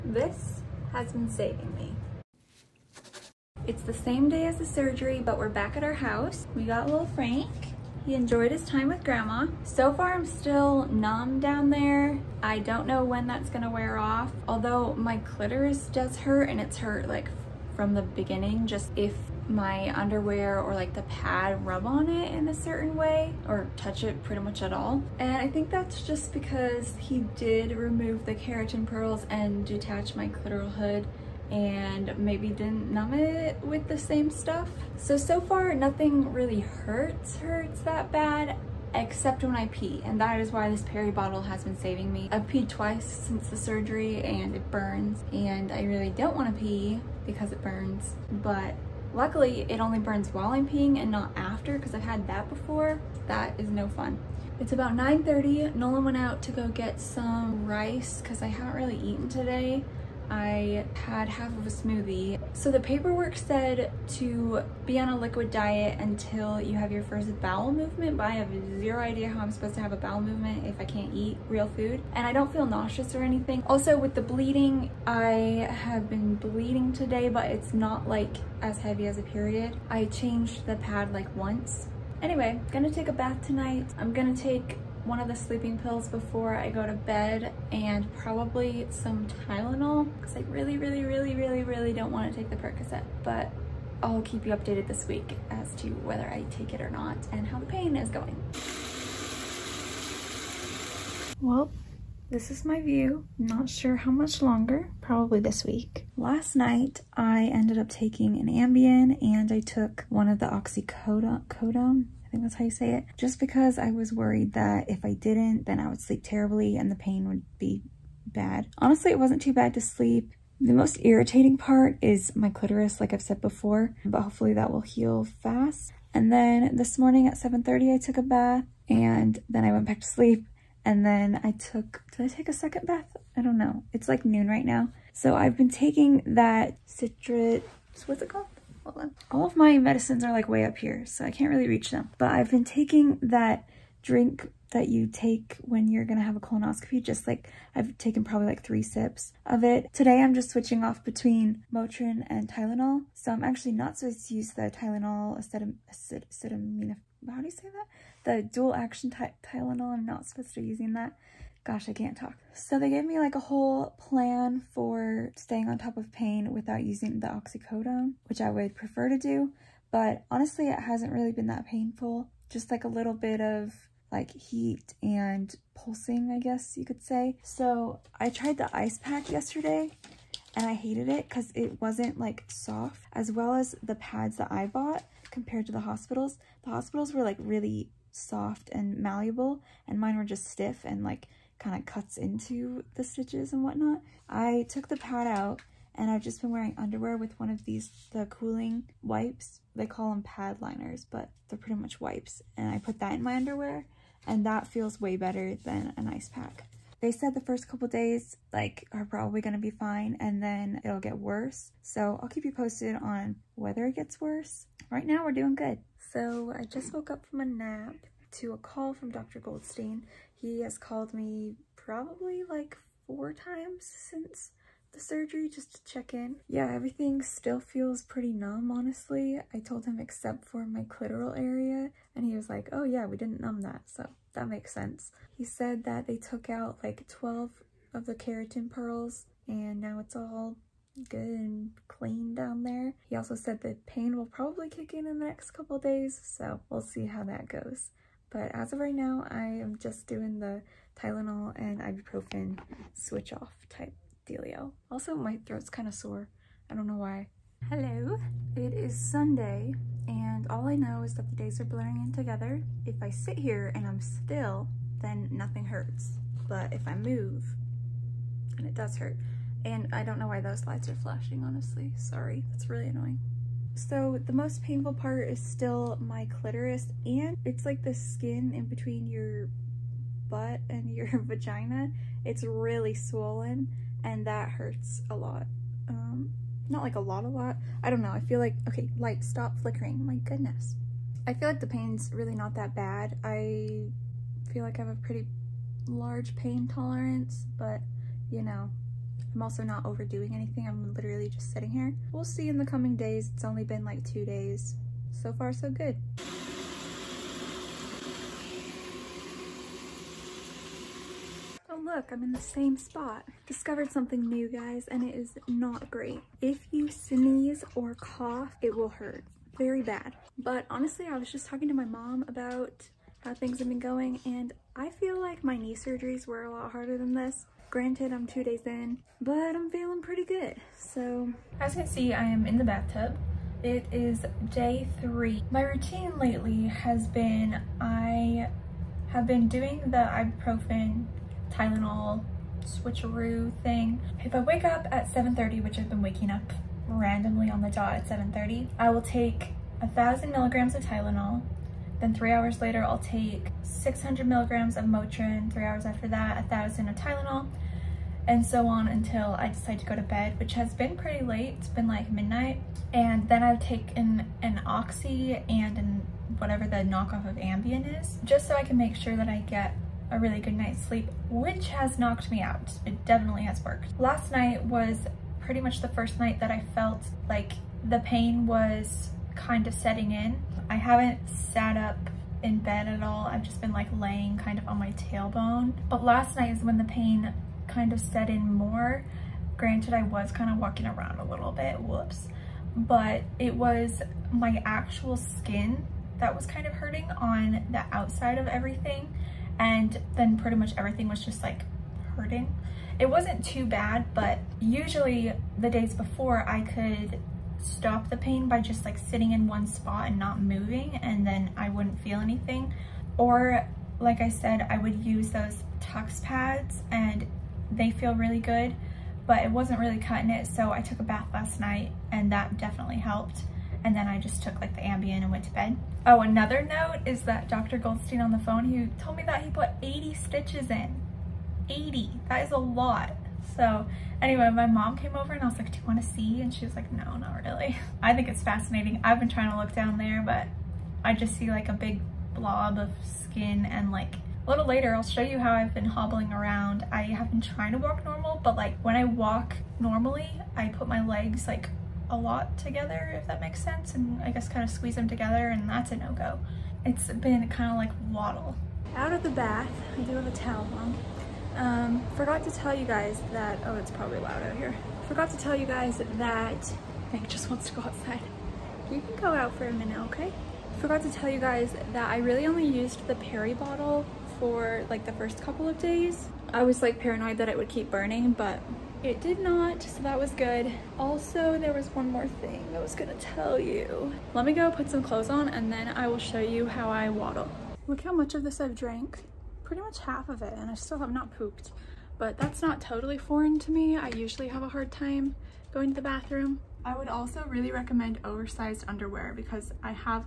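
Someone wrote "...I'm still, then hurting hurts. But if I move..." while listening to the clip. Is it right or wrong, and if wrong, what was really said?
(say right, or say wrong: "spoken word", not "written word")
wrong: "nothing", not "hurting".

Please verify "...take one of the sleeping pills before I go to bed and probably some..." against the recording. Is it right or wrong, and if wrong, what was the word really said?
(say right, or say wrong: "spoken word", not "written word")
right.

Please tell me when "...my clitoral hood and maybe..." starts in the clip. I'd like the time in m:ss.
0:30.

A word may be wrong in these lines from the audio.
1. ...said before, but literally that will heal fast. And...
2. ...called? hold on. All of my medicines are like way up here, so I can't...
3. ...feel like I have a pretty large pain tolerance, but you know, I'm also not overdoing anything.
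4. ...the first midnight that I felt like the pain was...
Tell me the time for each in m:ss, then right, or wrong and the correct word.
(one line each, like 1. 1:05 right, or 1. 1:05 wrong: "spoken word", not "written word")
1. 2:03 wrong: "hopefully", not "literally"
2. 2:18 right
3. 4:54 right
4. 6:15 wrong: "night", not "midnight".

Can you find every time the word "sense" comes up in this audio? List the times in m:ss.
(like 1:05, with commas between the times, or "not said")
3:54, 7:33.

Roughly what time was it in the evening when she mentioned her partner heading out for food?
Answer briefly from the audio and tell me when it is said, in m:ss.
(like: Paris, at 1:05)
9:30, at 0:54.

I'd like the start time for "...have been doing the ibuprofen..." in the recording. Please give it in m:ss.
5:39.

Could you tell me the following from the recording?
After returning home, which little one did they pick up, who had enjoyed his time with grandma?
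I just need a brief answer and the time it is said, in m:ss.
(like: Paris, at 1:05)
Frank, at 0:07.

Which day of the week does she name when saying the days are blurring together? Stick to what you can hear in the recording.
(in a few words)
Sunday.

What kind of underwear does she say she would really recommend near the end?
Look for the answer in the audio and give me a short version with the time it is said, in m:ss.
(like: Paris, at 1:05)
Oversized underwear, at 8:18.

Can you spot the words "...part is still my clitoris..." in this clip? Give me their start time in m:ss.
4:34.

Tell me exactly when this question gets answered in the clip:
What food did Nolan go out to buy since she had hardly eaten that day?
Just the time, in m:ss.
0:57.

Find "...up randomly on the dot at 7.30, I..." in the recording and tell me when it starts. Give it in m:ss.
5:46.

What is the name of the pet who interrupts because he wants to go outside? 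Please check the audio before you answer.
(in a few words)
Hank.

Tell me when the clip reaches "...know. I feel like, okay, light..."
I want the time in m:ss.
4:48.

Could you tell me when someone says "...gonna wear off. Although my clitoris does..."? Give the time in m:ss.
0:13.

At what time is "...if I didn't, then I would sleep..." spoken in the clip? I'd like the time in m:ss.
1:54.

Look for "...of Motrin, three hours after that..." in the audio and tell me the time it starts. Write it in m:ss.
5:54.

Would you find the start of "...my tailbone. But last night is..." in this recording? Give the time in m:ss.
6:24.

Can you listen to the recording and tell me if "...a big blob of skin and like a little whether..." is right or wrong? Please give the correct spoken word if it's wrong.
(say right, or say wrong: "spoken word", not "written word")
wrong: "later", not "whether".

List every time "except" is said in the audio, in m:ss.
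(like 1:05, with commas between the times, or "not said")
0:38, 3:49.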